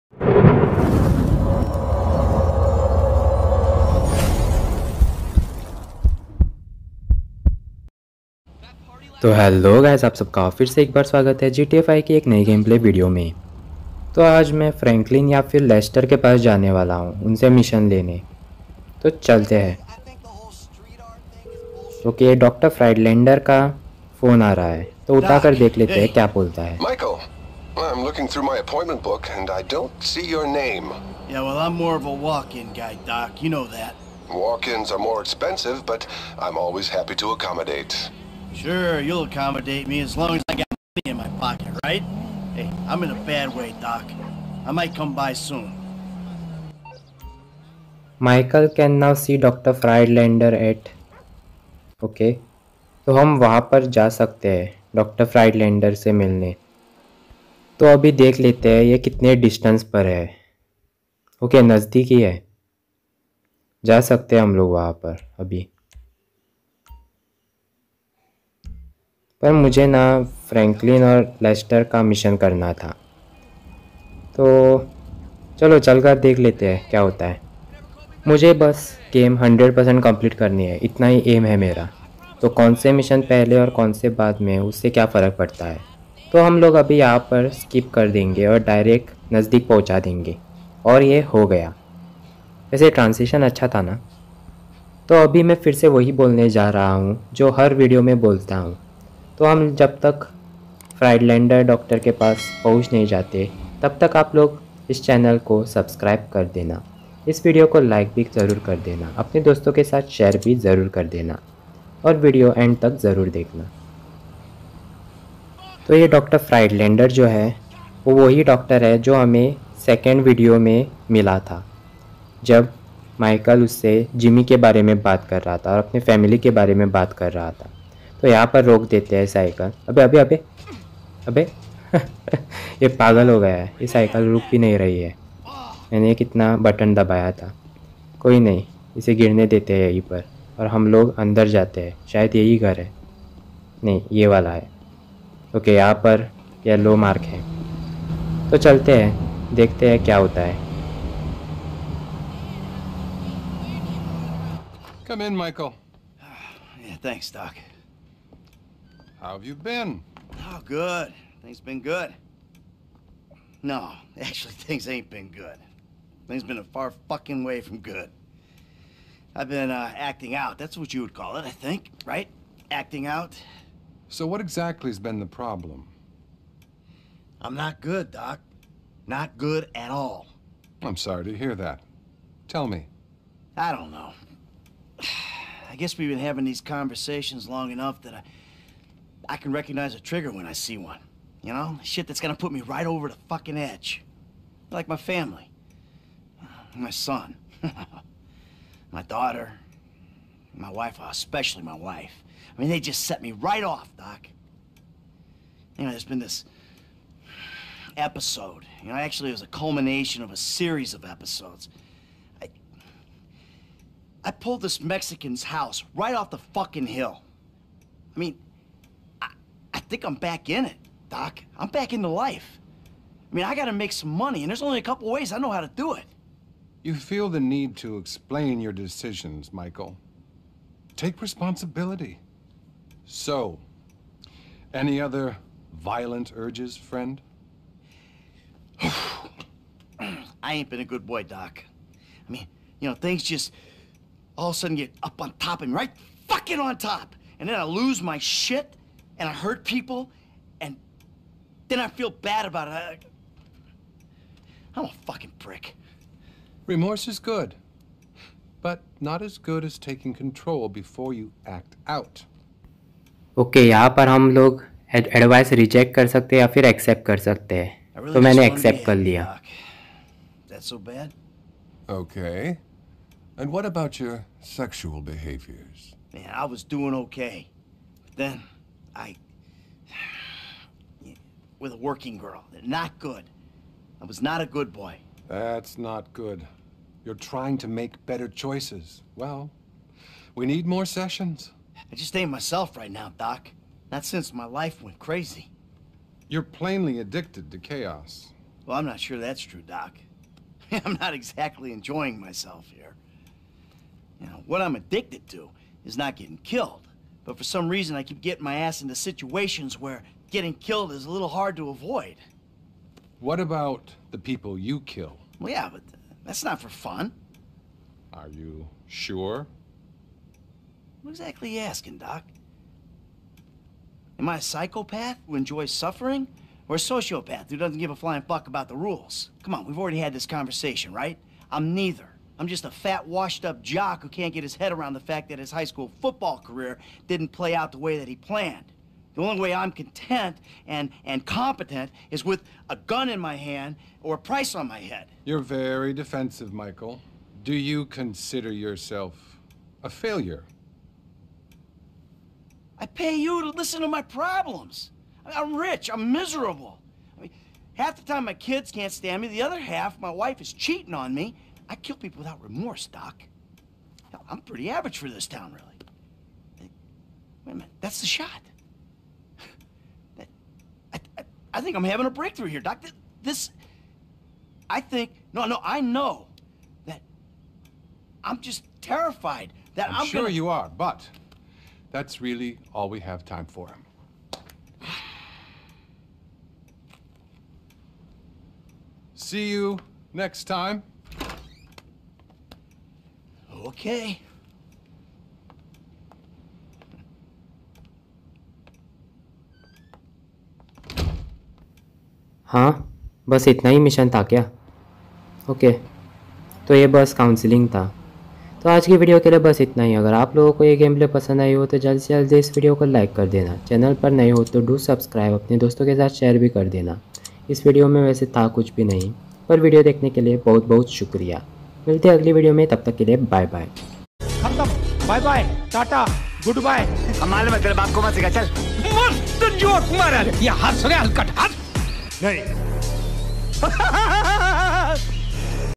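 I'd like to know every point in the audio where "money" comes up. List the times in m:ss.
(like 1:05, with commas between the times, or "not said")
0:40, 3:44.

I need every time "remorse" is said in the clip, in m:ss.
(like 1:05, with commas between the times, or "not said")
4:16, 6:02.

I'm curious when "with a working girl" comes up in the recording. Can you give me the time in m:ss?
4:41.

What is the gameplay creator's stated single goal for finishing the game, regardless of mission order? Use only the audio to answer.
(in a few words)
100 percent complete.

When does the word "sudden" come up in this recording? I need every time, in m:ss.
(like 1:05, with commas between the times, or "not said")
4:04.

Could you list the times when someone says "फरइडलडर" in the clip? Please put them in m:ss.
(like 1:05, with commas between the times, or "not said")
0:22, 0:49, 0:55, 1:40, 1:56.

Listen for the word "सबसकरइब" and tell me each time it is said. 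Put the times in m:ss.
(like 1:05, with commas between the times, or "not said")
1:45, 6:54.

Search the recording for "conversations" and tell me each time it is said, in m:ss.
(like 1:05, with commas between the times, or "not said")
3:06, 5:30.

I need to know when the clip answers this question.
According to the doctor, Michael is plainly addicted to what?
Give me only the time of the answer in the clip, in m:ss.
4:57.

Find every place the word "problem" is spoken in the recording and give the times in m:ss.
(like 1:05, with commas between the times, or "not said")
2:55, 5:54.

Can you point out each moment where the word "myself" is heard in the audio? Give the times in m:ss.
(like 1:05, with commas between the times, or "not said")
4:52, 5:02.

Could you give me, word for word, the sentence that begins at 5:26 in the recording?
Or a sociopath who doesn't give a flying fuck about the rules?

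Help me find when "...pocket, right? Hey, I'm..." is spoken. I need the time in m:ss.
0:41.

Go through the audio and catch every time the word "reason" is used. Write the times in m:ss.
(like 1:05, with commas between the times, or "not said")
5:07.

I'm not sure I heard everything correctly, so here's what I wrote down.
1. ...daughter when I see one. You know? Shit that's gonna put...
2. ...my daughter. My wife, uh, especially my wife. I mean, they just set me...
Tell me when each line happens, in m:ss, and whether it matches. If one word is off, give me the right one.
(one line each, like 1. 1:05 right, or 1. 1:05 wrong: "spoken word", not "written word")
1. 3:09 wrong: "trigger", not "daughter"
2. 3:18 right.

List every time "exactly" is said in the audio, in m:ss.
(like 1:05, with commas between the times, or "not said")
2:54, 5:01, 5:21.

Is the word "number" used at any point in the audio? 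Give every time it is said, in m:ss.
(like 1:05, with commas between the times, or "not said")
not said.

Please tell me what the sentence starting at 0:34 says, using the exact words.
Walk-ins are more expensive, but I'm always happy to accommodate.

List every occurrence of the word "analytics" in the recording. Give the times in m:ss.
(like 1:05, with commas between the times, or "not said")
not said.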